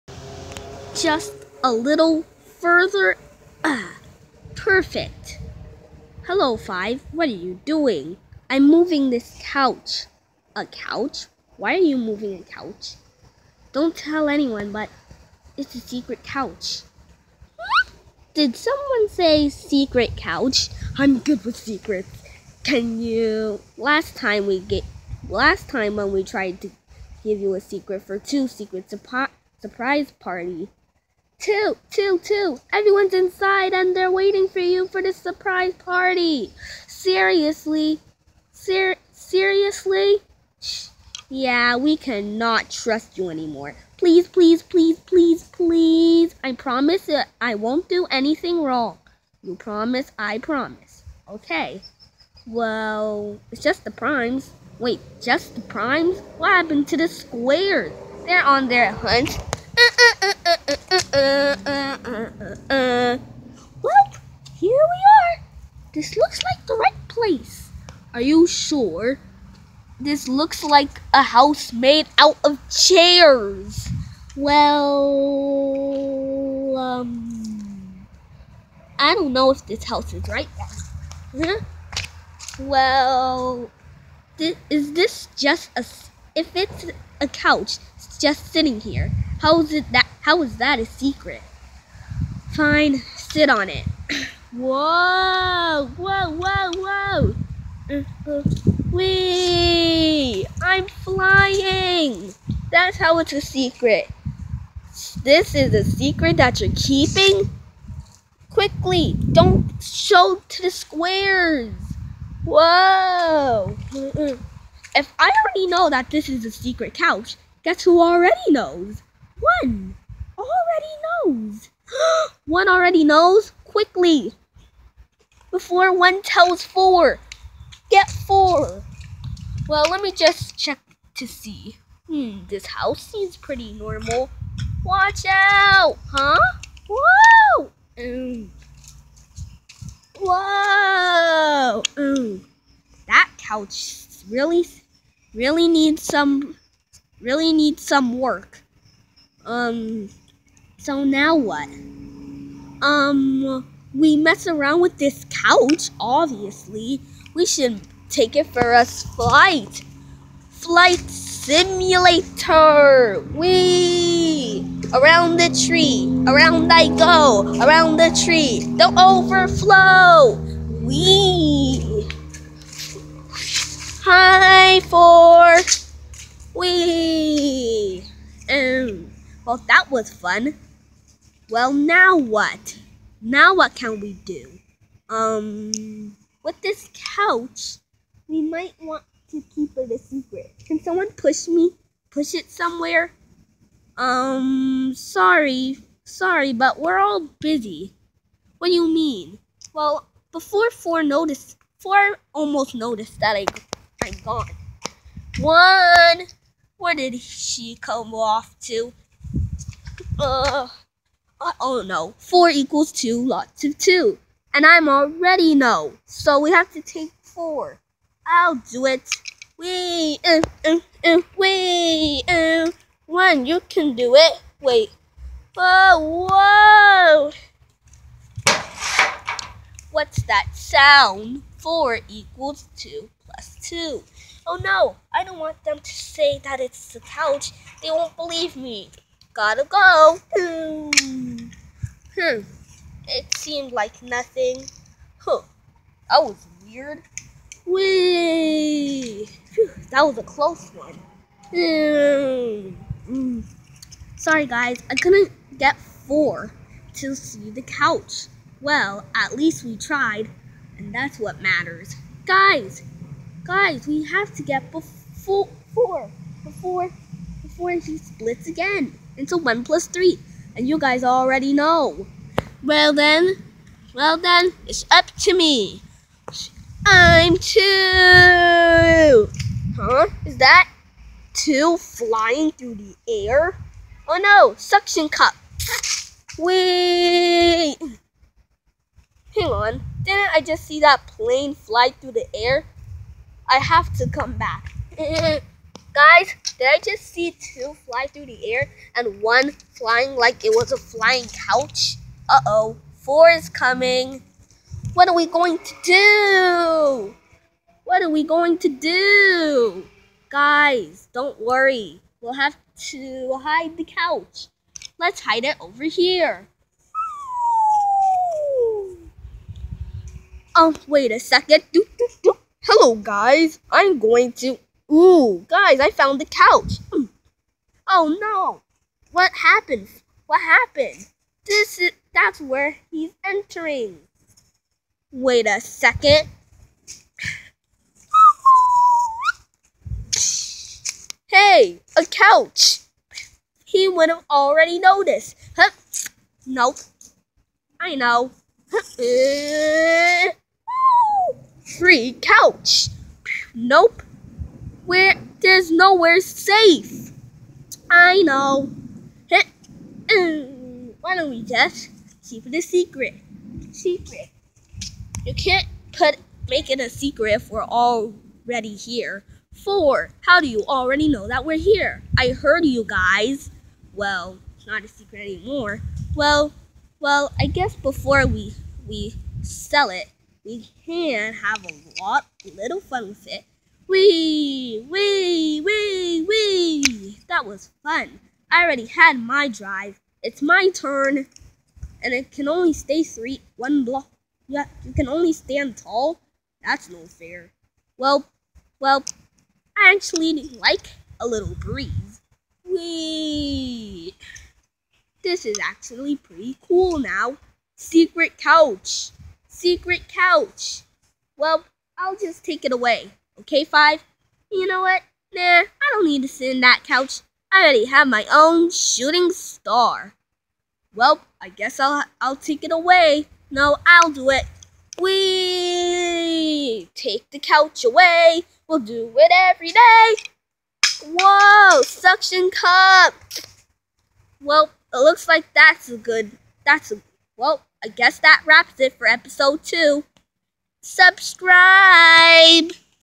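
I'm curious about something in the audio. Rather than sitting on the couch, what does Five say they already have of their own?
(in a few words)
shooting star.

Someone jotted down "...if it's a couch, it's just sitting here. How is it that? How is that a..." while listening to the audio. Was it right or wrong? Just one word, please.
right.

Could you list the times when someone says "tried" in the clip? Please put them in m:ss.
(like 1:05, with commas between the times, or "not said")
0:26, 4:19.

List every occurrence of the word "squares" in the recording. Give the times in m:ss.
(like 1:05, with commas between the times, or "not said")
0:57, 1:50.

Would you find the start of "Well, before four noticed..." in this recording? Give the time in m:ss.
3:19.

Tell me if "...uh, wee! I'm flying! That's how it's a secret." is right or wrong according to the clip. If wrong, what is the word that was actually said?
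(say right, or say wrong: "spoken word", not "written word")
right.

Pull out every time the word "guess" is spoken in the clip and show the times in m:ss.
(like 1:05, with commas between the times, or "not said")
1:57, 6:17, 7:01, 7:17.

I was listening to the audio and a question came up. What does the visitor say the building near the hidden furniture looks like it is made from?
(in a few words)
chairs.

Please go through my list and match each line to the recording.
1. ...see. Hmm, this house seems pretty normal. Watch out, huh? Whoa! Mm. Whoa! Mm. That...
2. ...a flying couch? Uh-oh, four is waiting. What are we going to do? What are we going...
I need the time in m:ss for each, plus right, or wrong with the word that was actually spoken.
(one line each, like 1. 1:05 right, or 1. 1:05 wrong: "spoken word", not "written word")
1. 2:11 right
2. 5:00 wrong: "coming", not "waiting".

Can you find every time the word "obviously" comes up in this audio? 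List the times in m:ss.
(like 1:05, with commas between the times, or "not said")
2:35.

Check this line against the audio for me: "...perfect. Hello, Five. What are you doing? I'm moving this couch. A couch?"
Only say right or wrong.
right.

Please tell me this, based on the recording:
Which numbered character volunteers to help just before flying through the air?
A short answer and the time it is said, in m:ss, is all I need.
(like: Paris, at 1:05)
2, at 4:36.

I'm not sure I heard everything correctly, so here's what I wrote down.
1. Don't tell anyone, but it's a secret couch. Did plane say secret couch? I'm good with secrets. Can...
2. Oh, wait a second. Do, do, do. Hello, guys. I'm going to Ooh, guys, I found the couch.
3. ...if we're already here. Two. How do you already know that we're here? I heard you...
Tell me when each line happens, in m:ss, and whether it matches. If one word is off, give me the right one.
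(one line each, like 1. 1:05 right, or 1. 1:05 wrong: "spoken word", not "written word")
1. 0:13 wrong: "someone", not "plane"
2. 5:20 right
3. 6:07 wrong: "Four", not "Two".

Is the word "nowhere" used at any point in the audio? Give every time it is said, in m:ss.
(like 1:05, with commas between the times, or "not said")
5:55.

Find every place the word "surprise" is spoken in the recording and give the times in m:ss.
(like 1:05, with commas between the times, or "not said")
0:28, 0:35.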